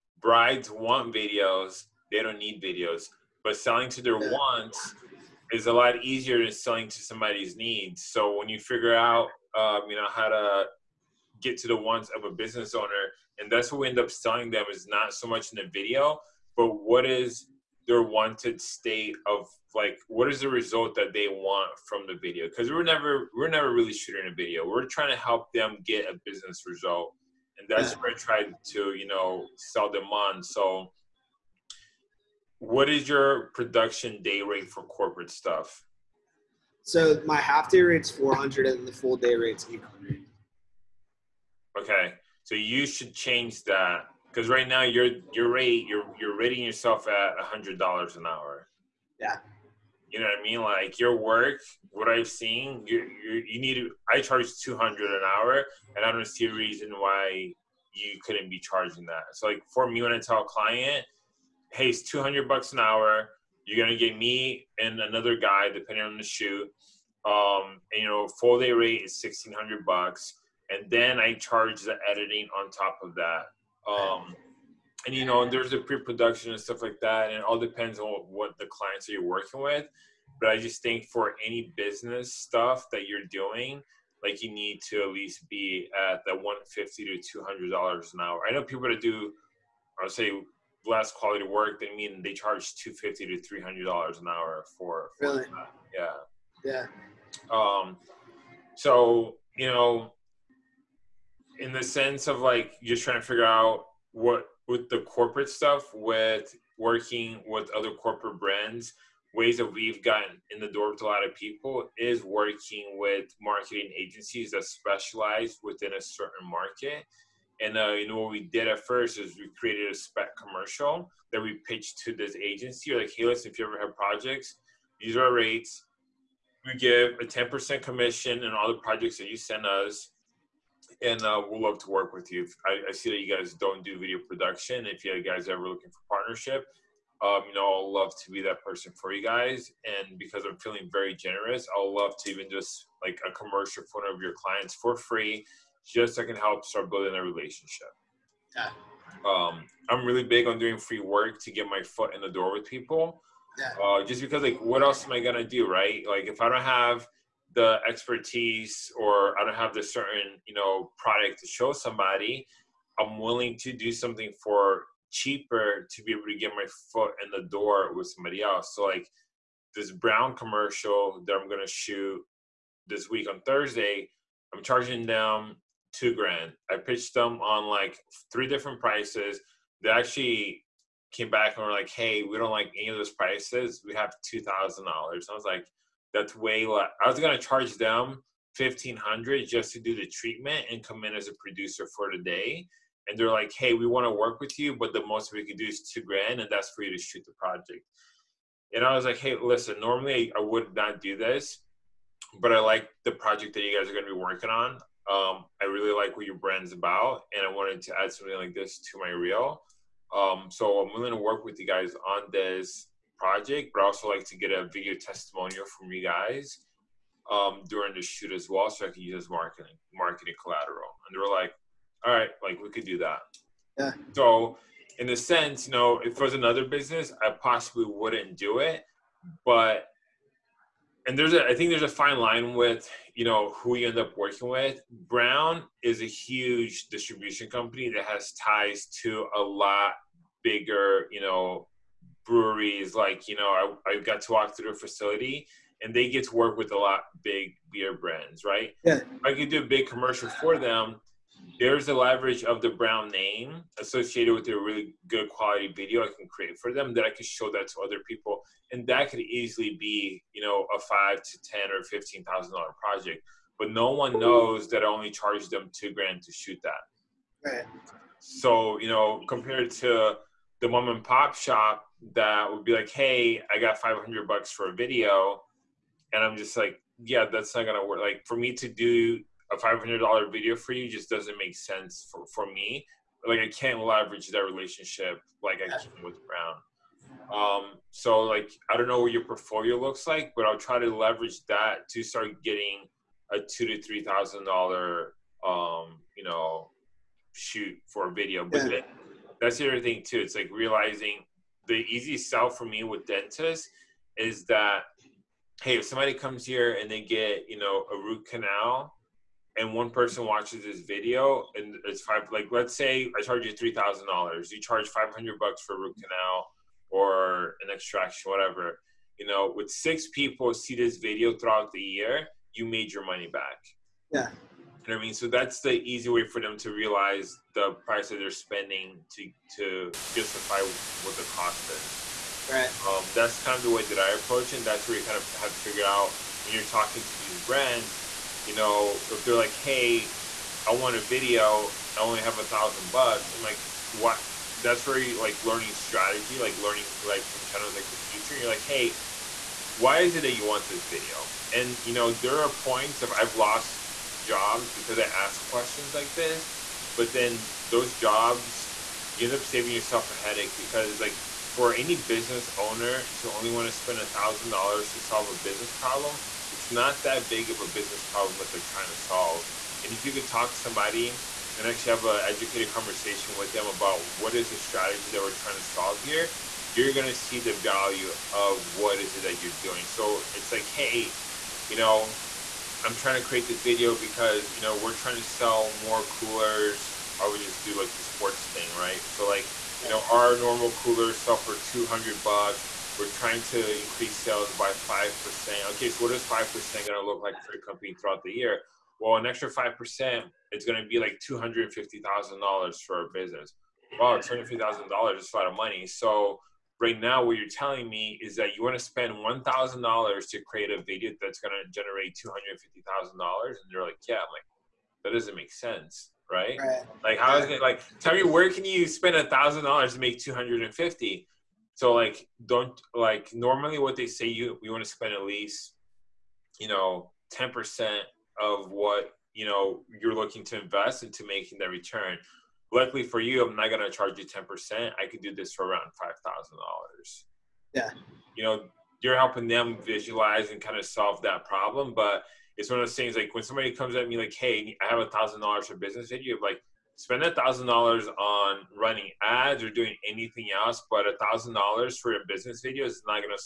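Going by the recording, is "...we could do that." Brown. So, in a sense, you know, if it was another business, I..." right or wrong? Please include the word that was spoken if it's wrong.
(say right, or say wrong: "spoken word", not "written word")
wrong: "Yeah", not "Brown".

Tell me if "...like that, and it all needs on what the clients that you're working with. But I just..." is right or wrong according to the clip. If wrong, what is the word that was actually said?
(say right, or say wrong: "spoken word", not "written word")
wrong: "depends", not "needs".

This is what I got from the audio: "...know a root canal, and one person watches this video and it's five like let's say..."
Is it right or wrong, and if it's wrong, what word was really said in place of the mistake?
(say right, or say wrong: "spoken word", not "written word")
right.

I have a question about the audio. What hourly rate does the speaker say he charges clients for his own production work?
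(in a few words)
$200.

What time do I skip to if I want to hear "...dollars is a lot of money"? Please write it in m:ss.
6:44.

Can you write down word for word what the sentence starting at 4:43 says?
Like, I can't leverage that relationship like I can with Brown.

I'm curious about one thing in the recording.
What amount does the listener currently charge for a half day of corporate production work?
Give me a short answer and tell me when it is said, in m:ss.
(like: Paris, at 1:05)
$400, at 0:38.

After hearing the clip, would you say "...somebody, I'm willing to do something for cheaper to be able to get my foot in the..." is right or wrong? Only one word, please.
right.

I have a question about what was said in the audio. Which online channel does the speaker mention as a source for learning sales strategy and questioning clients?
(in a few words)
The Futur.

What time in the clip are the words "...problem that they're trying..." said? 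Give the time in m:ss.
6:08.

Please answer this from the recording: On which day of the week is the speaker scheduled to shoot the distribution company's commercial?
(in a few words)
Thursday.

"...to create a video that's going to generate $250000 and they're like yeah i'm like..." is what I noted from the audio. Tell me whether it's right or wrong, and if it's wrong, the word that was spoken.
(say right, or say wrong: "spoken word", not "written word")
right.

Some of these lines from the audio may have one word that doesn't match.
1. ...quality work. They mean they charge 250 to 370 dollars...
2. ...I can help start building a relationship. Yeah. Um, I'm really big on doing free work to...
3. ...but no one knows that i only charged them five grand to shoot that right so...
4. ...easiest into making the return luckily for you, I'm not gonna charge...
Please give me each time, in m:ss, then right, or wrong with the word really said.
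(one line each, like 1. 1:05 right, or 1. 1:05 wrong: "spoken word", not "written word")
1. 1:31 wrong: "300", not "370"
2. 2:26 right
3. 4:23 wrong: "two", not "five"
4. 7:10 wrong: "invest", not "easiest".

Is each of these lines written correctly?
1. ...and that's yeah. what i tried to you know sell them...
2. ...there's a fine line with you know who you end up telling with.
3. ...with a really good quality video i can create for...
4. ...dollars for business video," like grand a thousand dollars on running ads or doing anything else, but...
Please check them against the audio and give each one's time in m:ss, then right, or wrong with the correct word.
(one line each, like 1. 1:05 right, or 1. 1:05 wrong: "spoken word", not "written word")
1. 0:27 right
2. 3:51 wrong: "working", not "telling"
3. 4:14 right
4. 7:25 wrong: "spend", not "grand".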